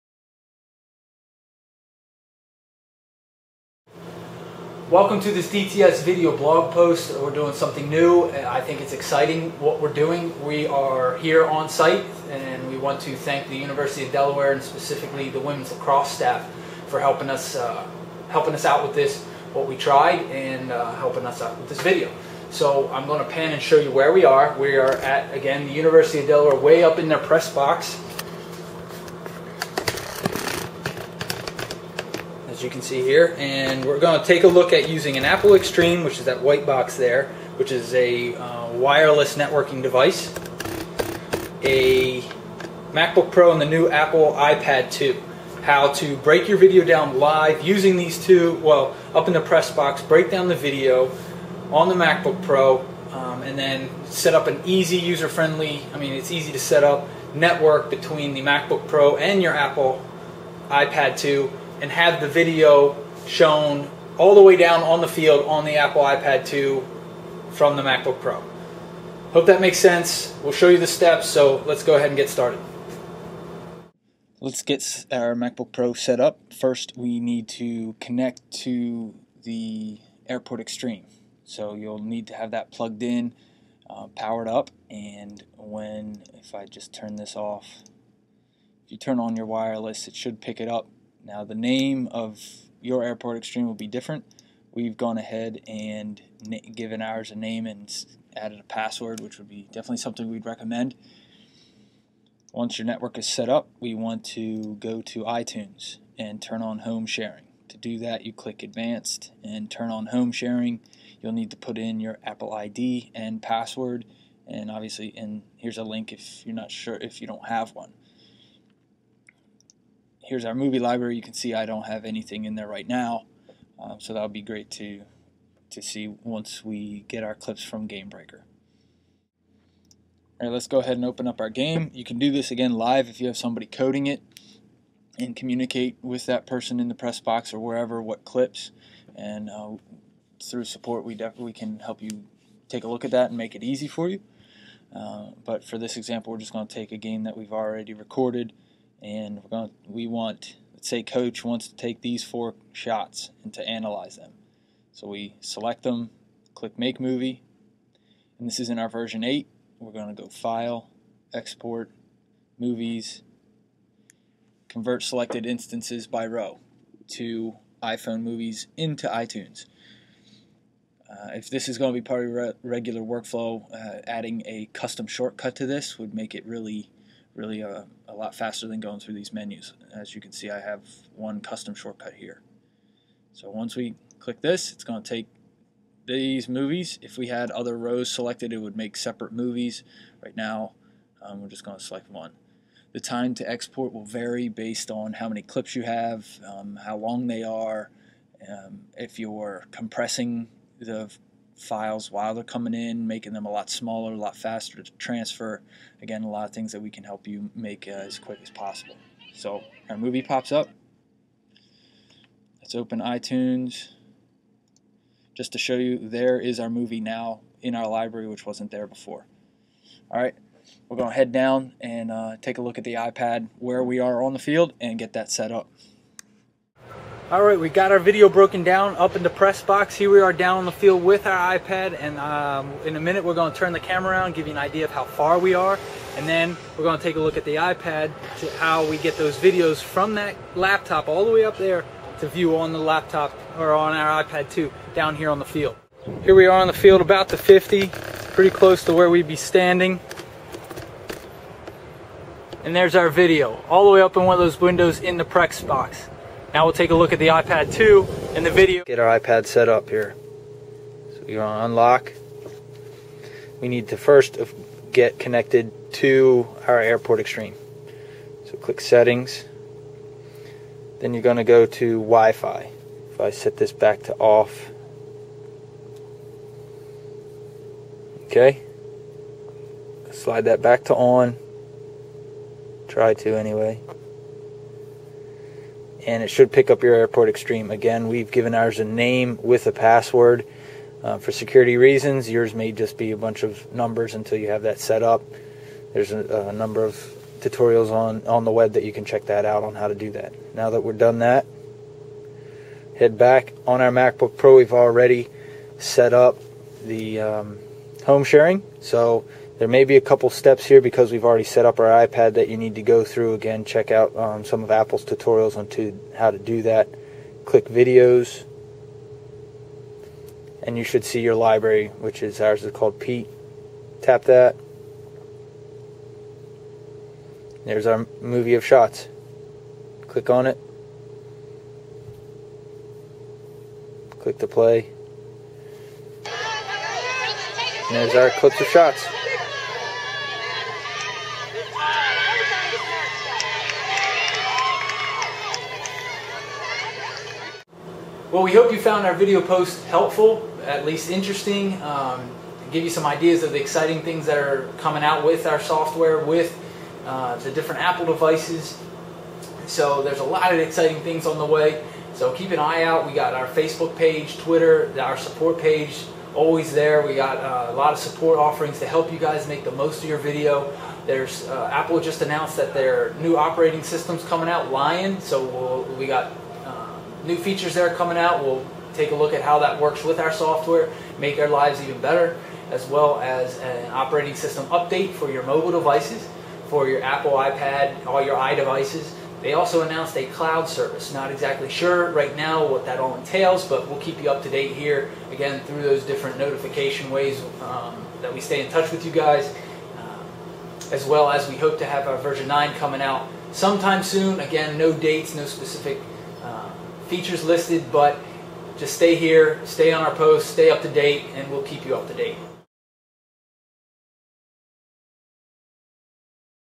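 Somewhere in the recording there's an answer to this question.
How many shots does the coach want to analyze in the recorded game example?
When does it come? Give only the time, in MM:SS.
02:32.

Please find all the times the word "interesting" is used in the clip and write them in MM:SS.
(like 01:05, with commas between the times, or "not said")
05:51.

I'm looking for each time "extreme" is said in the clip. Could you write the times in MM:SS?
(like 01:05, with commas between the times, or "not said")
00:35, 01:20, 01:33, 04:27, 04:47.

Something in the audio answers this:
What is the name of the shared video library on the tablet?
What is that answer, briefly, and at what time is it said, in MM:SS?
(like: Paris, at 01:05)
Pete, at 05:22.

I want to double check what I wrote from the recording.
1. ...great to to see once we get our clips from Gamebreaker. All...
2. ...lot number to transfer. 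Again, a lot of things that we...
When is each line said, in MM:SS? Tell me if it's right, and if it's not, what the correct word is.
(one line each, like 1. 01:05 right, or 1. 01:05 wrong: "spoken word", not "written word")
1. 02:04 right
2. 03:24 wrong: "faster", not "number".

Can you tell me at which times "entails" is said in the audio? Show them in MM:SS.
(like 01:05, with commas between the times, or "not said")
06:33.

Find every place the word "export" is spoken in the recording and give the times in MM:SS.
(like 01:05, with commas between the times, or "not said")
02:41, 03:13.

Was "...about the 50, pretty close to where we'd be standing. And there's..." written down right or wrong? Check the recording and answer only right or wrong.
right.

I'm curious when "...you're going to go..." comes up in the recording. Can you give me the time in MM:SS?
04:31.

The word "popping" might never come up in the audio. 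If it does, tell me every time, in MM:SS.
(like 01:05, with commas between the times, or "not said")
not said.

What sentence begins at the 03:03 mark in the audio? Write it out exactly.
So once we click this, it's going to take these movies.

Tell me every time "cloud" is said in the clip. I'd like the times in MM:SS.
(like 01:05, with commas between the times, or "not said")
06:30.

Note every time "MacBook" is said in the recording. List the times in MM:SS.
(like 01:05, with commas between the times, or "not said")
00:42, 00:51, 00:58, 01:07, 01:15, 05:03.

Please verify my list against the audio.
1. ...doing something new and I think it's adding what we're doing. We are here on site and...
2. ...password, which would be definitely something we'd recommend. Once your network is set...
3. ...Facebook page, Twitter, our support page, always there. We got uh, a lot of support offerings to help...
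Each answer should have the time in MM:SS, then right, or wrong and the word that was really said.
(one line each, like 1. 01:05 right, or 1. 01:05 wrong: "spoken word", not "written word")
1. 00:07 wrong: "exciting", not "adding"
2. 01:38 right
3. 06:03 right.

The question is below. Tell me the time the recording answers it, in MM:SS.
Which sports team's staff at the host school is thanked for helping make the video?
00:15.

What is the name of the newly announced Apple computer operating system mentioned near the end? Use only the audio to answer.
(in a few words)
Lion.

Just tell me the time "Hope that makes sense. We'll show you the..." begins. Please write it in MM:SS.
01:09.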